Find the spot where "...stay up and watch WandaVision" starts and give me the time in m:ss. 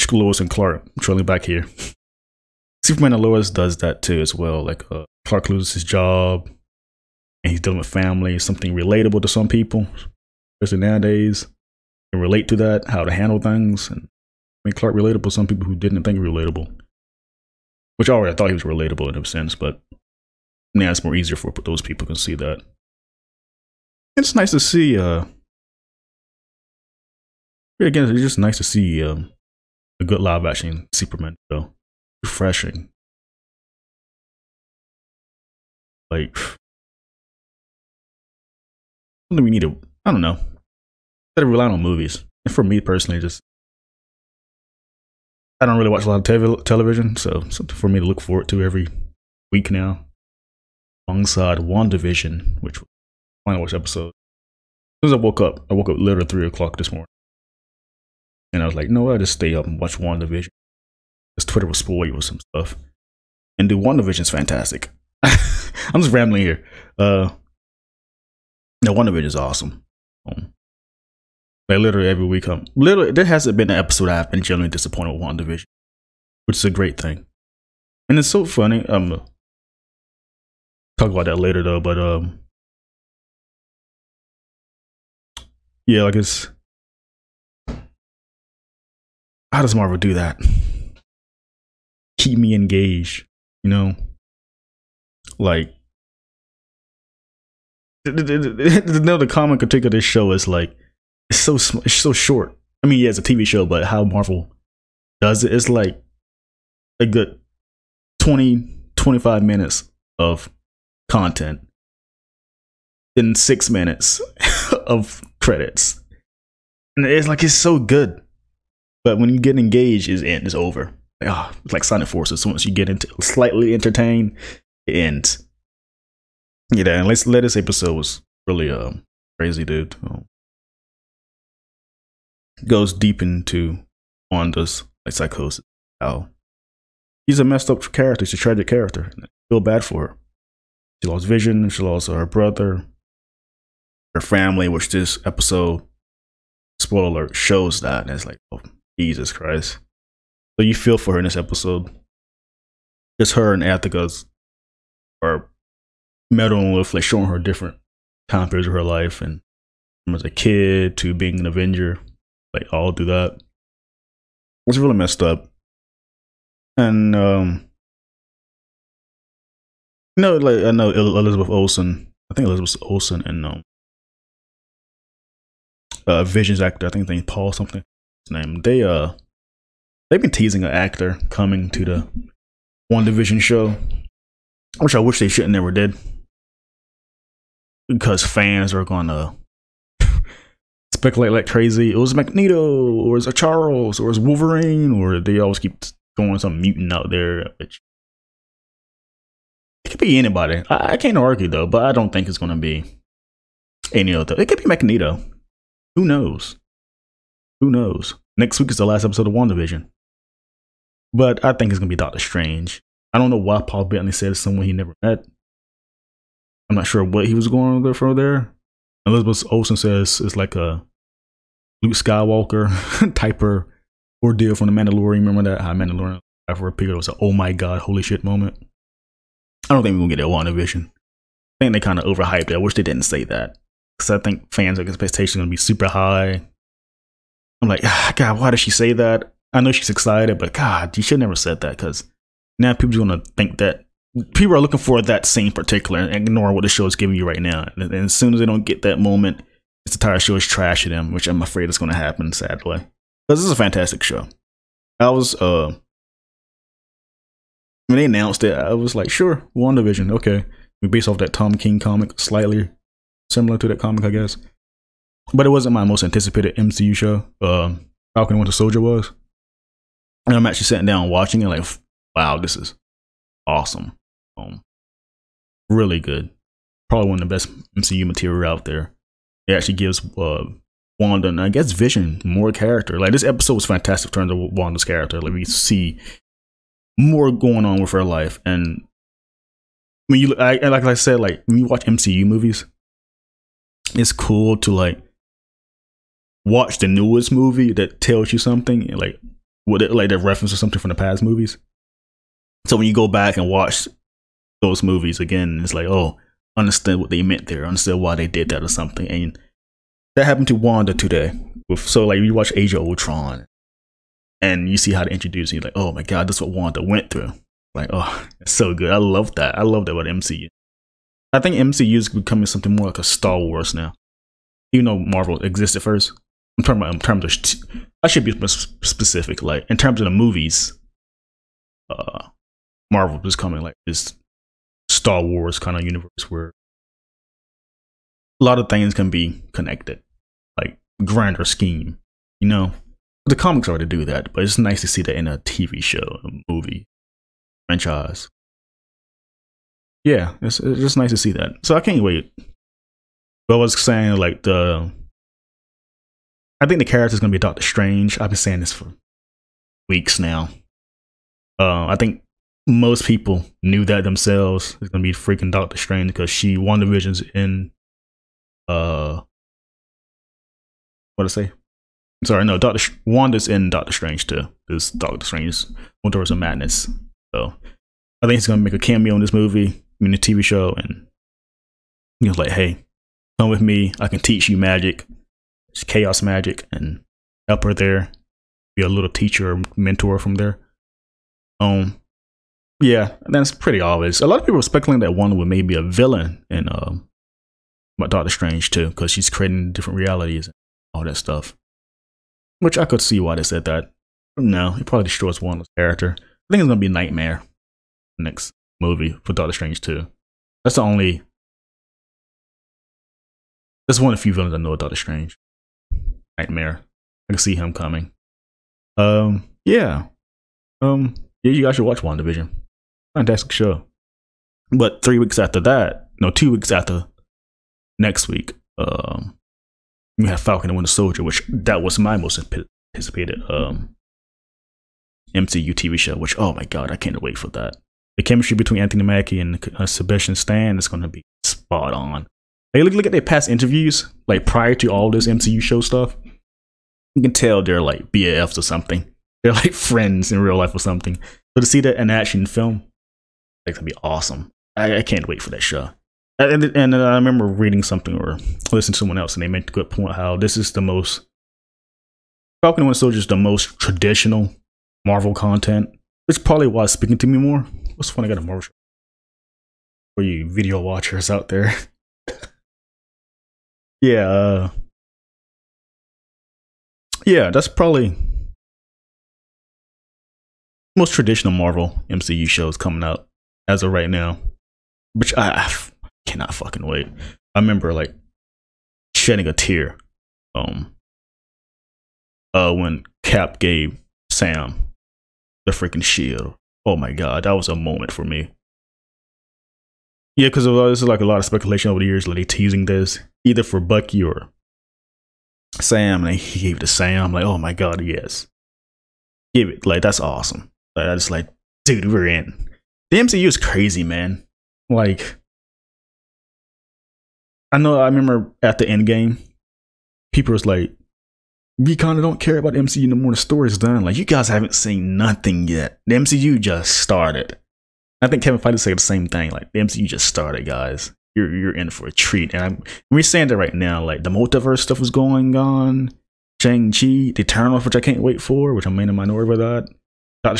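0:59.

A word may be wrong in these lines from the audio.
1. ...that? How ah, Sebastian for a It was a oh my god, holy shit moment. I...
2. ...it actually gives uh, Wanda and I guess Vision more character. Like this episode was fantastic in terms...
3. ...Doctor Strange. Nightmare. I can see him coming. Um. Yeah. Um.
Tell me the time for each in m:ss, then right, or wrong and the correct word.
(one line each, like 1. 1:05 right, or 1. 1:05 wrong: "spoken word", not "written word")
1. 3:45 wrong: "Mandalorian", not "Sebastian"
2. 4:39 right
3. 6:54 right.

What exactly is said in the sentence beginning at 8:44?
Like, you guys haven't seen nothing yet.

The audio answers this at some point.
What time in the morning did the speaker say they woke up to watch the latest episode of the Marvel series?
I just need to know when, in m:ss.
0:56.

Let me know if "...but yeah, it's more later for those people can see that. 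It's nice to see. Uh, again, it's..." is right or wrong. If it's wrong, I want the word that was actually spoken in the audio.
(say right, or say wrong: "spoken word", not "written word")
wrong: "easier", not "later".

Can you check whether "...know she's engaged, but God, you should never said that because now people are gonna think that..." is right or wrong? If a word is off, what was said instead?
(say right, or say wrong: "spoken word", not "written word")
wrong: "excited", not "engaged".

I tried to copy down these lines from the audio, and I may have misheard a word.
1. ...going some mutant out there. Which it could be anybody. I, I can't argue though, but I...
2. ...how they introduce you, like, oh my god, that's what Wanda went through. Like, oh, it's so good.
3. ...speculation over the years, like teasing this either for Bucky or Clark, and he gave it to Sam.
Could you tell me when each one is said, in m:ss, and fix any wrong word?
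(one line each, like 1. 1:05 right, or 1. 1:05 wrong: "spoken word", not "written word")
1. 3:16 right
2. 5:14 right
3. 8:21 wrong: "Sam", not "Clark".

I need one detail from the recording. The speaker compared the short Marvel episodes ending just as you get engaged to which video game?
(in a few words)
Sonic Forces.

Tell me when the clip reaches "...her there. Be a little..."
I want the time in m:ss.
6:27.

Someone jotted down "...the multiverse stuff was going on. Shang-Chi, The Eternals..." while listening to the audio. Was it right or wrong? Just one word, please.
right.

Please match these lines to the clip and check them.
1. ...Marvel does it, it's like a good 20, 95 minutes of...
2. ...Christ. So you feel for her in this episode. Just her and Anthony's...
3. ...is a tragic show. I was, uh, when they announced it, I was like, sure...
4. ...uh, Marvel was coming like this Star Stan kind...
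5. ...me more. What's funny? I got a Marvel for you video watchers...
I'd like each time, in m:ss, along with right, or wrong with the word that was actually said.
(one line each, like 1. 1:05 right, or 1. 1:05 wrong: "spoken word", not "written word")
1. 1:44 wrong: "25", not "95"
2. 2:29 wrong: "Agatha", not "Anthony"
3. 4:13 wrong: "fantastic", not "tragic"
4. 5:31 wrong: "Wars", not "Stan"
5. 7:47 right.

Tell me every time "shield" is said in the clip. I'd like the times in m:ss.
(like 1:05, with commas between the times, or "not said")
8:16.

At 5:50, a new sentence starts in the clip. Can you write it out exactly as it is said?
Yeah, it's, it's just nice to see that.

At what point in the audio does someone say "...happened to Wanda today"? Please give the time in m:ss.
5:10.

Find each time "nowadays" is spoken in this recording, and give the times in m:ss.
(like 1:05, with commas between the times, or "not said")
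0:10.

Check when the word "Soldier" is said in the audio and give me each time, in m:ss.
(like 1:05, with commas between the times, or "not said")
4:28, 7:10, 7:42.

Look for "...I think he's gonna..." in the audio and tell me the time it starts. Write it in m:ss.
6:18.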